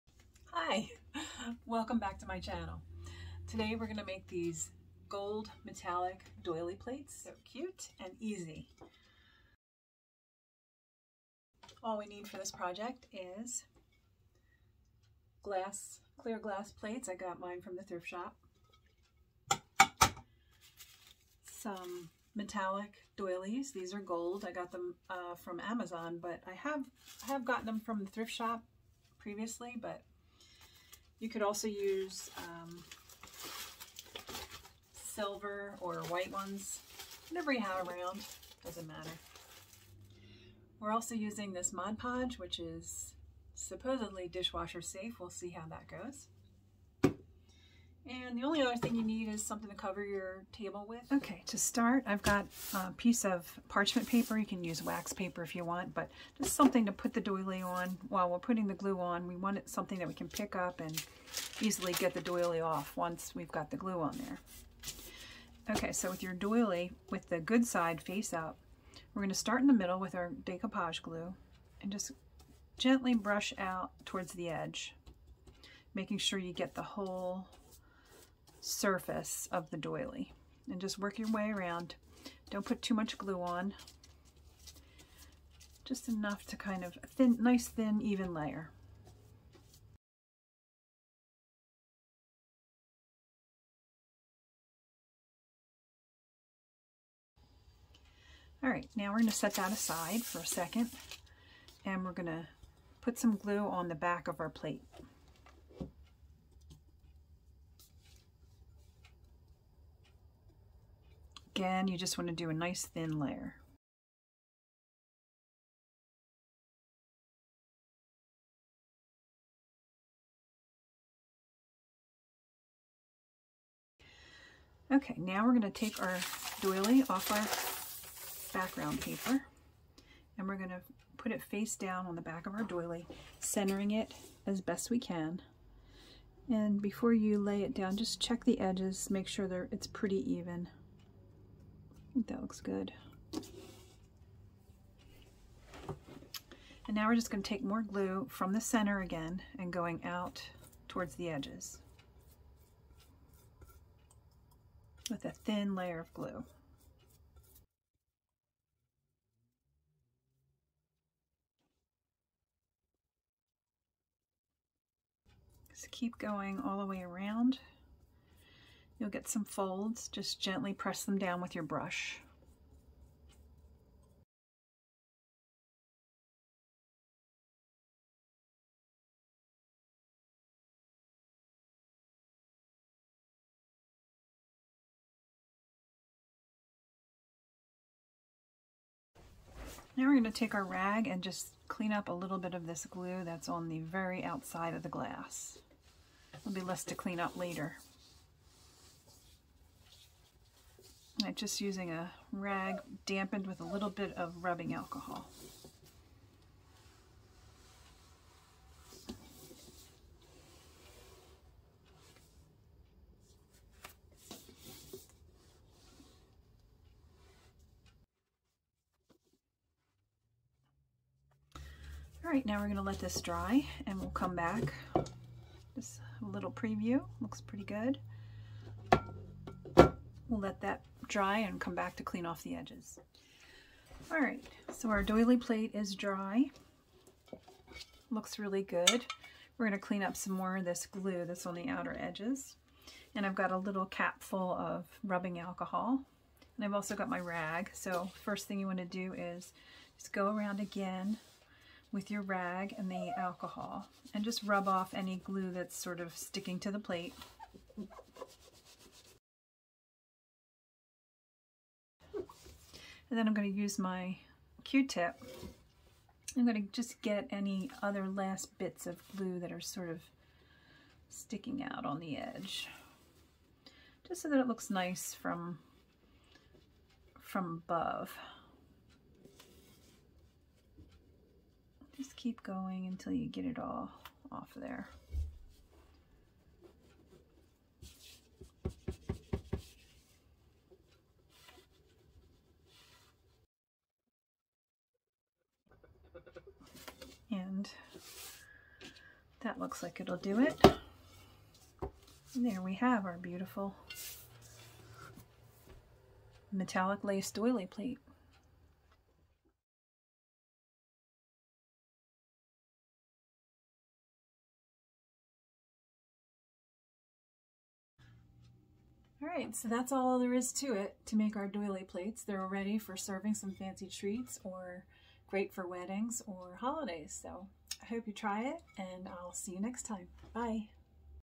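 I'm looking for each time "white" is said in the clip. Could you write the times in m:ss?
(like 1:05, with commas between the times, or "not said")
0:36.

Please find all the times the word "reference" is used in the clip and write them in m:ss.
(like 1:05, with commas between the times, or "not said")
not said.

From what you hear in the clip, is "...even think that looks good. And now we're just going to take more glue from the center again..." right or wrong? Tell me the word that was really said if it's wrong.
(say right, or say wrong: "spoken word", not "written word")
right.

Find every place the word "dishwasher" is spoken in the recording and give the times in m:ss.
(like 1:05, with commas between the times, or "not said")
0:44.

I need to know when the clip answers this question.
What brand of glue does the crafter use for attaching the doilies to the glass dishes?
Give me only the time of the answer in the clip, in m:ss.
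0:41.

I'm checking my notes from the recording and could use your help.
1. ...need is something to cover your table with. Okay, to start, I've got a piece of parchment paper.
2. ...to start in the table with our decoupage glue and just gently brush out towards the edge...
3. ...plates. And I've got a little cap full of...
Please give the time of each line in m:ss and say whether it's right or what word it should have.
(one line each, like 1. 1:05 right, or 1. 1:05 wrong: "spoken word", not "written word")
1. 0:49 right
2. 1:09 wrong: "middle", not "table"
3. 4:01 wrong: "edges", not "plates".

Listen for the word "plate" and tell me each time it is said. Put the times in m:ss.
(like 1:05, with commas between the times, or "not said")
0:06, 0:16, 1:44, 3:55, 4:16, 5:07, 5:21.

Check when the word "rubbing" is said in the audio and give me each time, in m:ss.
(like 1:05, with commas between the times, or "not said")
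3:24, 4:05.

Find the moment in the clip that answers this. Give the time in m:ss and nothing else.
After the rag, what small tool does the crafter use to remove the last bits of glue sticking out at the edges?
4:24.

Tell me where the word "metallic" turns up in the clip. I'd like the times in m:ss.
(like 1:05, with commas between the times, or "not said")
0:05, 0:22, 5:06.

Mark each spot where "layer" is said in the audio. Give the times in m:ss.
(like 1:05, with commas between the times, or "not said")
1:28, 1:53, 2:35.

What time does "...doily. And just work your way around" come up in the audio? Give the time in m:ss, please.
1:19.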